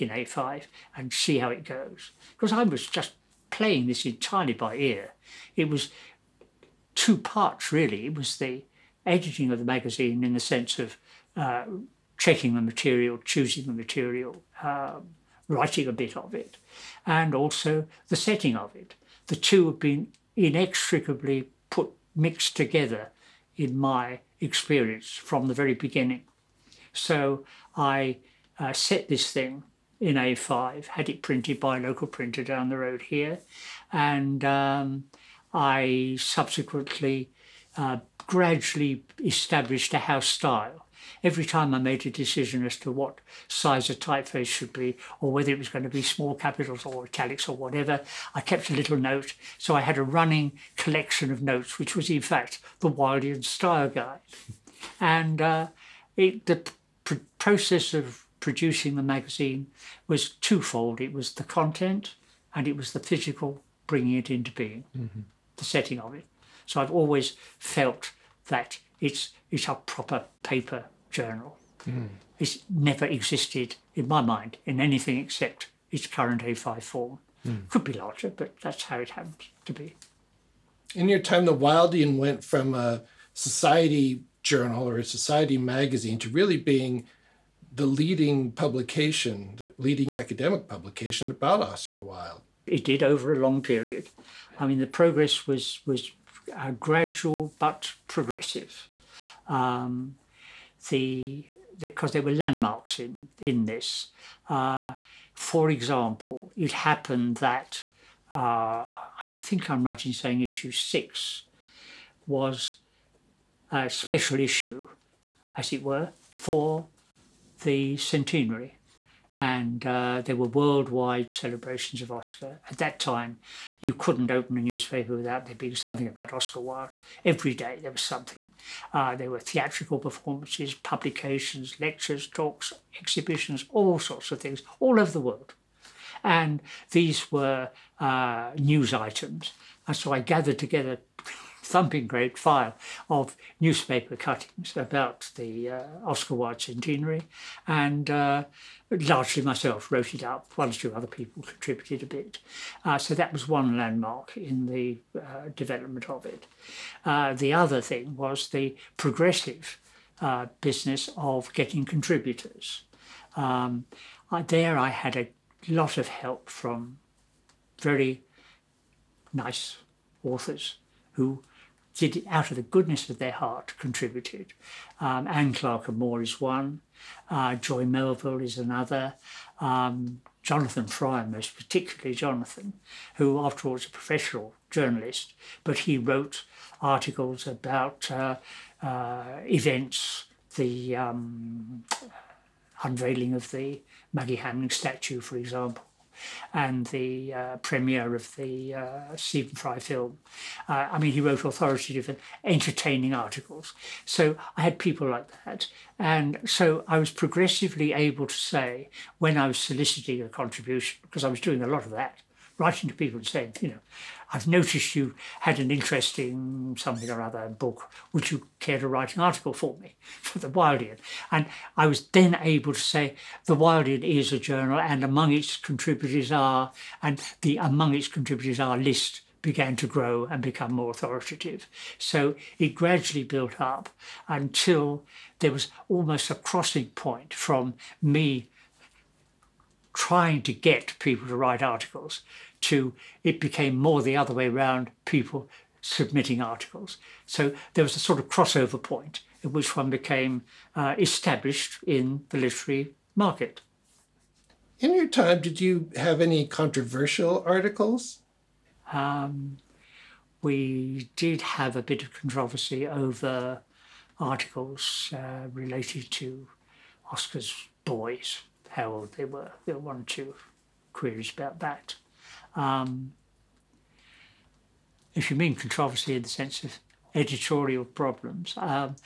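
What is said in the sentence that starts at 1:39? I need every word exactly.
Um, the because the, there were landmarks in in this.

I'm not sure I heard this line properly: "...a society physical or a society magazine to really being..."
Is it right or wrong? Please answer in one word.
wrong.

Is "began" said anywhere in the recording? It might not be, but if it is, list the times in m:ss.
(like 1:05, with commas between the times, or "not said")
3:49.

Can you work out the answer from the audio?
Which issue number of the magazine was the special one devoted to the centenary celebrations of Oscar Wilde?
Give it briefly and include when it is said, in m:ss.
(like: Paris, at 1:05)
6, at 1:50.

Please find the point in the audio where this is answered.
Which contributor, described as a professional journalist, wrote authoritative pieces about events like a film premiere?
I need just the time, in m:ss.
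3:00.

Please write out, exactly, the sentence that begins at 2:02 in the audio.
At that time, you couldn't open a newspaper without there being something about Oscar Wilde.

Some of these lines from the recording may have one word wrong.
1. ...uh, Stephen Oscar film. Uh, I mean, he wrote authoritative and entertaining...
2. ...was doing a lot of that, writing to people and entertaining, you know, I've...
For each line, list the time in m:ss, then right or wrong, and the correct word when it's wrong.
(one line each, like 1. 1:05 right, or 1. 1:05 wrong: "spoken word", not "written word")
1. 3:18 wrong: "Fry", not "Oscar"
2. 3:31 wrong: "saying", not "entertaining".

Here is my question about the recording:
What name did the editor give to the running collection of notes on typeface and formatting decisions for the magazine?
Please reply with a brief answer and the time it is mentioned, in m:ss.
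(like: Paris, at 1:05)
Wildean Style Guide, at 0:52.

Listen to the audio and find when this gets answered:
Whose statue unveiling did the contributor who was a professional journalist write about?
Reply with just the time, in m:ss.
3:14.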